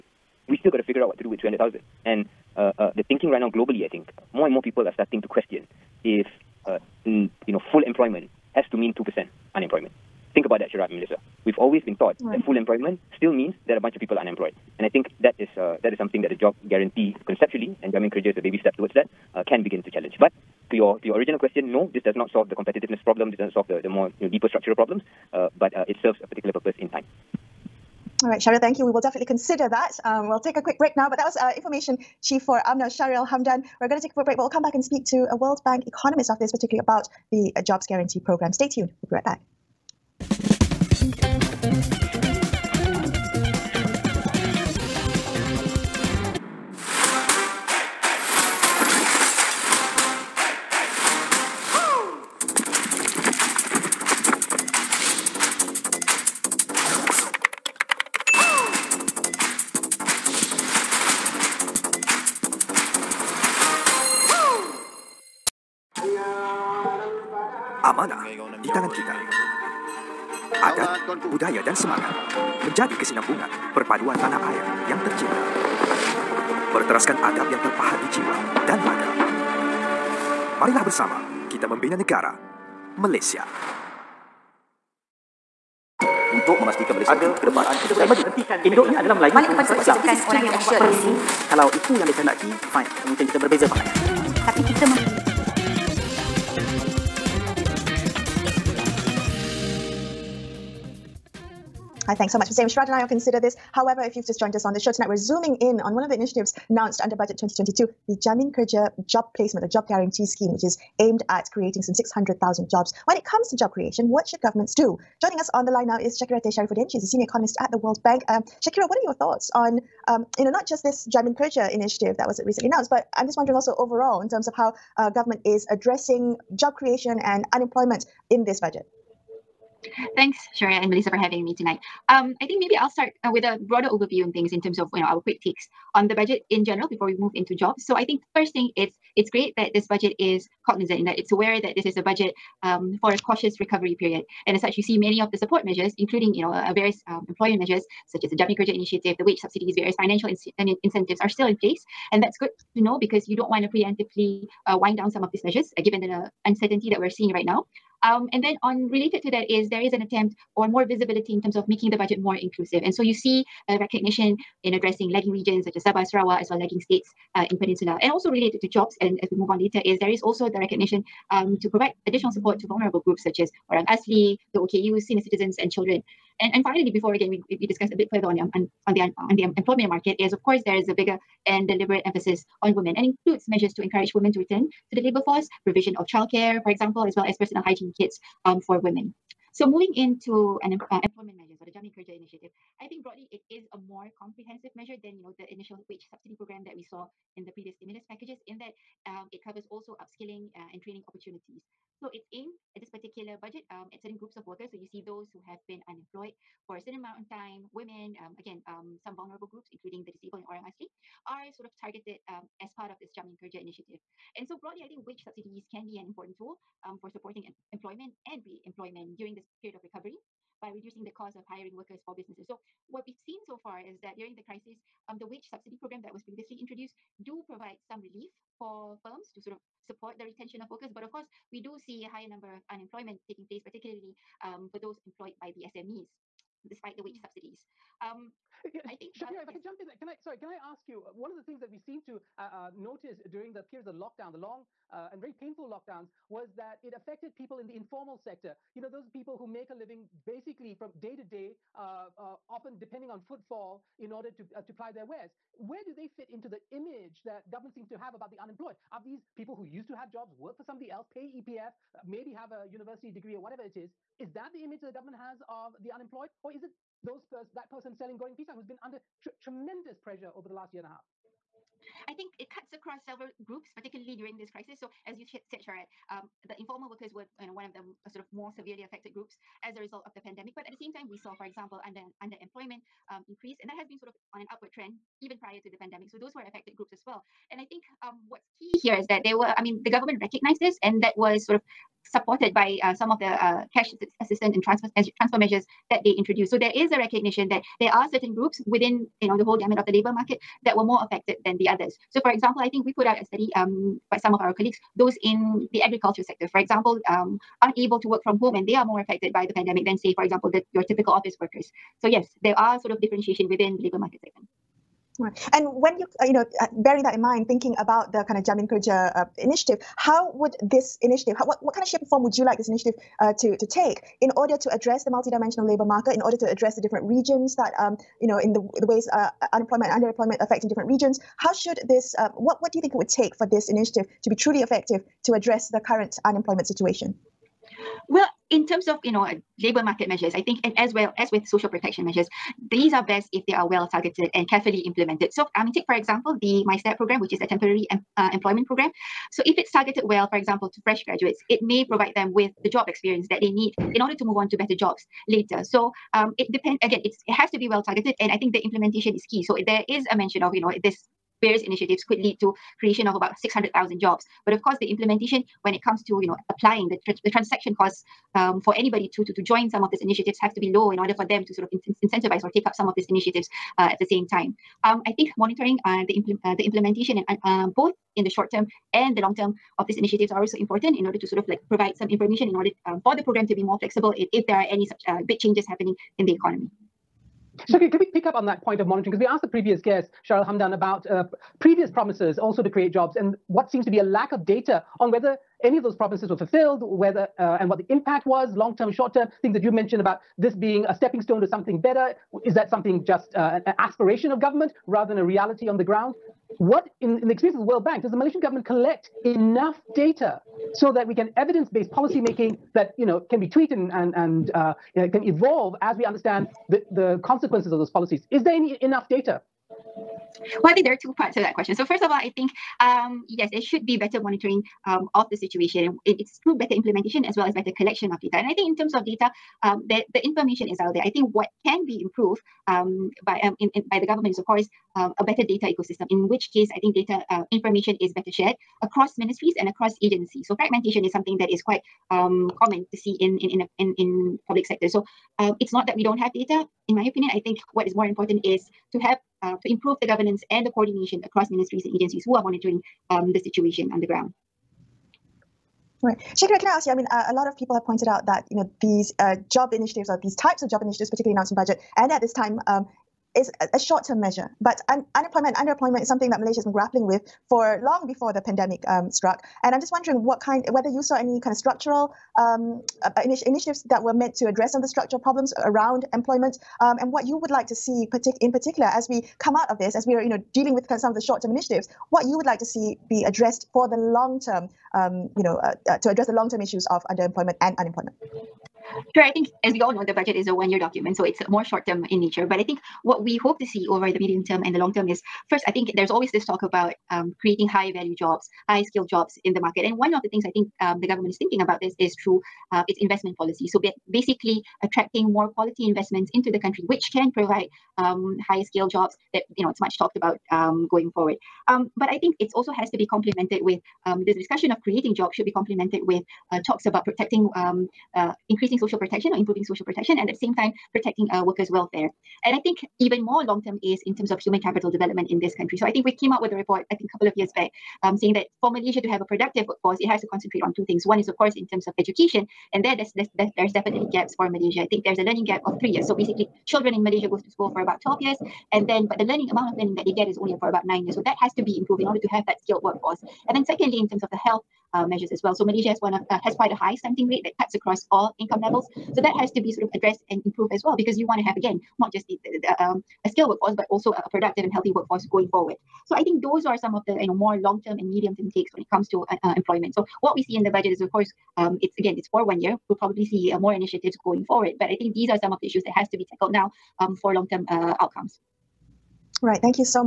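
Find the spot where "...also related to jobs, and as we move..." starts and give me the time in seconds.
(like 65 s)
168 s.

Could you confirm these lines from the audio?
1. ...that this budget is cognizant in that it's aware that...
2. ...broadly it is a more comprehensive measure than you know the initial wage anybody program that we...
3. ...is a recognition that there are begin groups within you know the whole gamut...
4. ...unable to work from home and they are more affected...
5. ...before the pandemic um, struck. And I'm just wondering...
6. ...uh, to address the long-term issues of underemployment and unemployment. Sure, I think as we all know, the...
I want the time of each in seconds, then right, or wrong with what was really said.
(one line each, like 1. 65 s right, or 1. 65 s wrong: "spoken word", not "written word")
1. 139 s right
2. 193 s wrong: "subsidy", not "anybody"
3. 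296 s wrong: "certain", not "begin"
4. 307 s right
5. 468 s right
6. 485 s right.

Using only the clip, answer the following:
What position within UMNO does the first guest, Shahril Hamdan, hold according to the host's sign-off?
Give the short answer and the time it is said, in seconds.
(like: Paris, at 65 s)
Information chief, at 31 s.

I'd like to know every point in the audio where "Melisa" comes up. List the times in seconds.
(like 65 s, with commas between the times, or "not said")
10 s, 130 s.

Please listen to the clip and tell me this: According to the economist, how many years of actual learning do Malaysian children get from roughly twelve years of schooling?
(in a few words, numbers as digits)
9 years.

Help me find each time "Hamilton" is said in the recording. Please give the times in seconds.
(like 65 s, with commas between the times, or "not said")
not said.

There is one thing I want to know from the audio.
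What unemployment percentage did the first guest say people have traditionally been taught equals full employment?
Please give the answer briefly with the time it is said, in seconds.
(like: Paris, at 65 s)
2%, at 8 s.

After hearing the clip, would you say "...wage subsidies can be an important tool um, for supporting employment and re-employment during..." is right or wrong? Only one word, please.
right.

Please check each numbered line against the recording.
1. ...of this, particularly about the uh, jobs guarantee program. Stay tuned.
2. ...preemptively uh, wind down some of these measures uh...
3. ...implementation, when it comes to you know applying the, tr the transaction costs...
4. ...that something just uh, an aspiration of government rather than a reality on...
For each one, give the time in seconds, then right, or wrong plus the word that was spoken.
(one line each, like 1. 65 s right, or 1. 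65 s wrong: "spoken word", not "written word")
1. 36 s right
2. 153 s right
3. 364 s right
4. 402 s right.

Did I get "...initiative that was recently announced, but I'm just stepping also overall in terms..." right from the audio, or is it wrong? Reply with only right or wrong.
wrong.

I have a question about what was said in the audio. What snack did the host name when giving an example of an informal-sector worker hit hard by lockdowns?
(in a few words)
Goreng pisang.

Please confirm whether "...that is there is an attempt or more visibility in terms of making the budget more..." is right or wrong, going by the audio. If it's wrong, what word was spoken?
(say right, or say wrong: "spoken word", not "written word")
right.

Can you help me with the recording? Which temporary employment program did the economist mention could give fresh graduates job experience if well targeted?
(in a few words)
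MySTEP.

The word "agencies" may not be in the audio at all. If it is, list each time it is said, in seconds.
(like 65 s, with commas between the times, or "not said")
440 s, 451 s.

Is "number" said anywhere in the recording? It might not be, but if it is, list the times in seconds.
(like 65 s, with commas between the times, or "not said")
232 s.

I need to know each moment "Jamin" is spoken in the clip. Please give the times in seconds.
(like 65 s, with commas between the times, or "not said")
17 s, 108 s, 121 s, 191 s, 213 s, 318 s.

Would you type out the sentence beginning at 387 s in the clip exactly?
So can we pick up on that point of monitoring?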